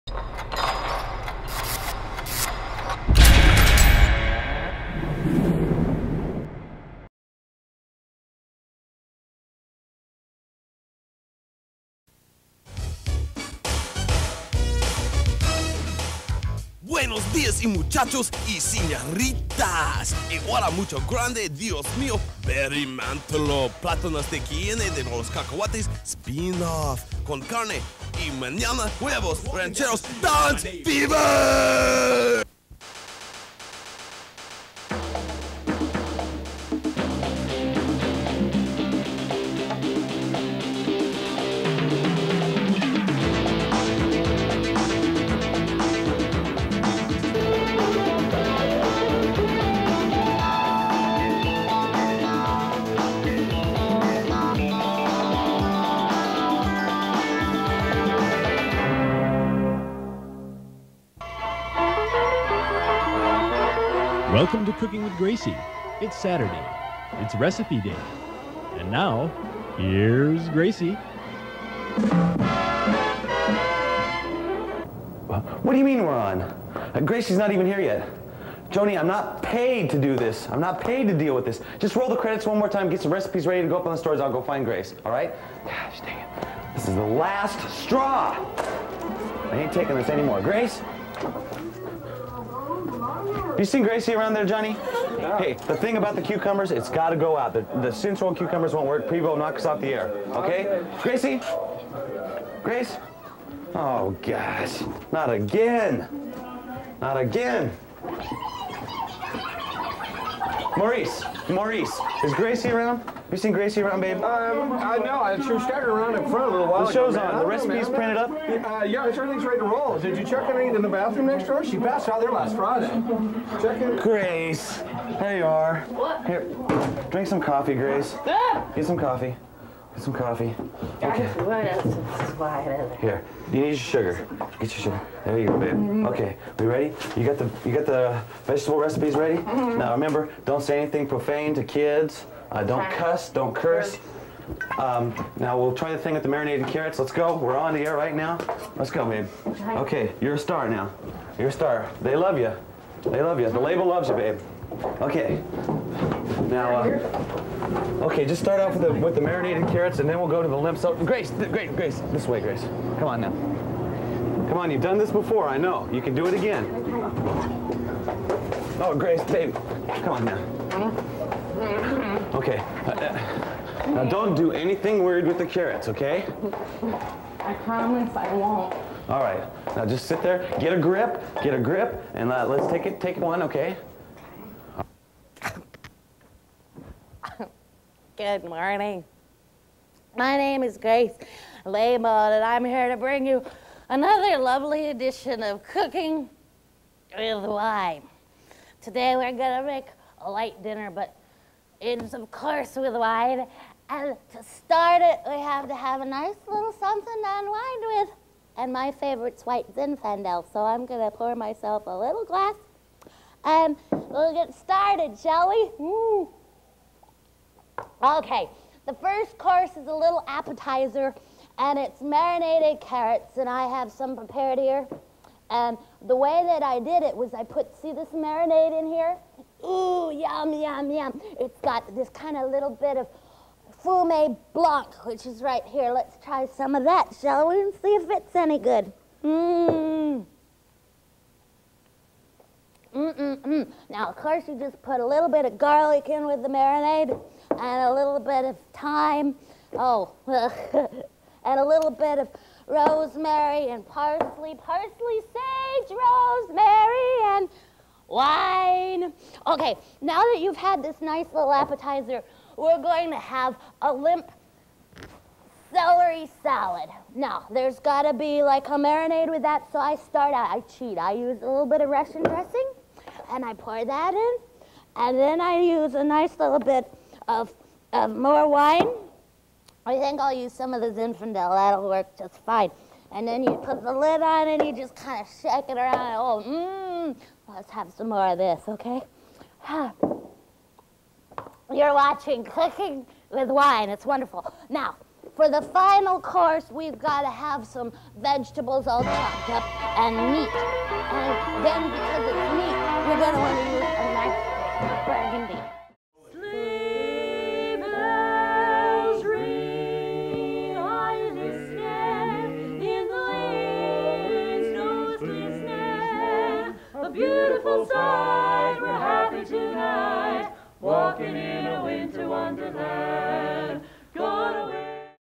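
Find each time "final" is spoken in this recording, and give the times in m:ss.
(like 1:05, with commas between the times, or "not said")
4:55.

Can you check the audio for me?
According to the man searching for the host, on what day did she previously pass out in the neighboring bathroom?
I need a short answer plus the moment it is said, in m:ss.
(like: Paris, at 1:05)
Friday, at 2:02.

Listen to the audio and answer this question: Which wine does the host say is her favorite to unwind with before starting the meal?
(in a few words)
White Zinfandel.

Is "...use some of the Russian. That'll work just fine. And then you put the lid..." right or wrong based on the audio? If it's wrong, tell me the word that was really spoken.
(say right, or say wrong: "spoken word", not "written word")
wrong: "Zinfandel", not "Russian".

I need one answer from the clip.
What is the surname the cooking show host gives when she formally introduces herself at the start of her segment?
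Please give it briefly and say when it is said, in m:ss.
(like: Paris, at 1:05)
Laymon, at 3:11.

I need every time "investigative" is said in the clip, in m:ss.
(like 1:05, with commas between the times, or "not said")
not said.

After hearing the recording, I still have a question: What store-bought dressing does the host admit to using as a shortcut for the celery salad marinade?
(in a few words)
Russian dressing.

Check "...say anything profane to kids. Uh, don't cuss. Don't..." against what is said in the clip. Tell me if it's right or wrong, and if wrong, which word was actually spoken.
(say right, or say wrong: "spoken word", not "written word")
right.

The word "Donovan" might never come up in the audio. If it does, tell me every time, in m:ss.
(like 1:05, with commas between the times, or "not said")
not said.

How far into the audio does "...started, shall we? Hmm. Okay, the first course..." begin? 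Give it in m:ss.
3:34.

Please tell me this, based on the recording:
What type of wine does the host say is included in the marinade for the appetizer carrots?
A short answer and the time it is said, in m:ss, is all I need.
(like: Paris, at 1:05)
Fume Blanc, at 3:53.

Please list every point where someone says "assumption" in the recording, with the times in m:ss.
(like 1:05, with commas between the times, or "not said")
not said.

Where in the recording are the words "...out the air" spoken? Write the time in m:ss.
1:39.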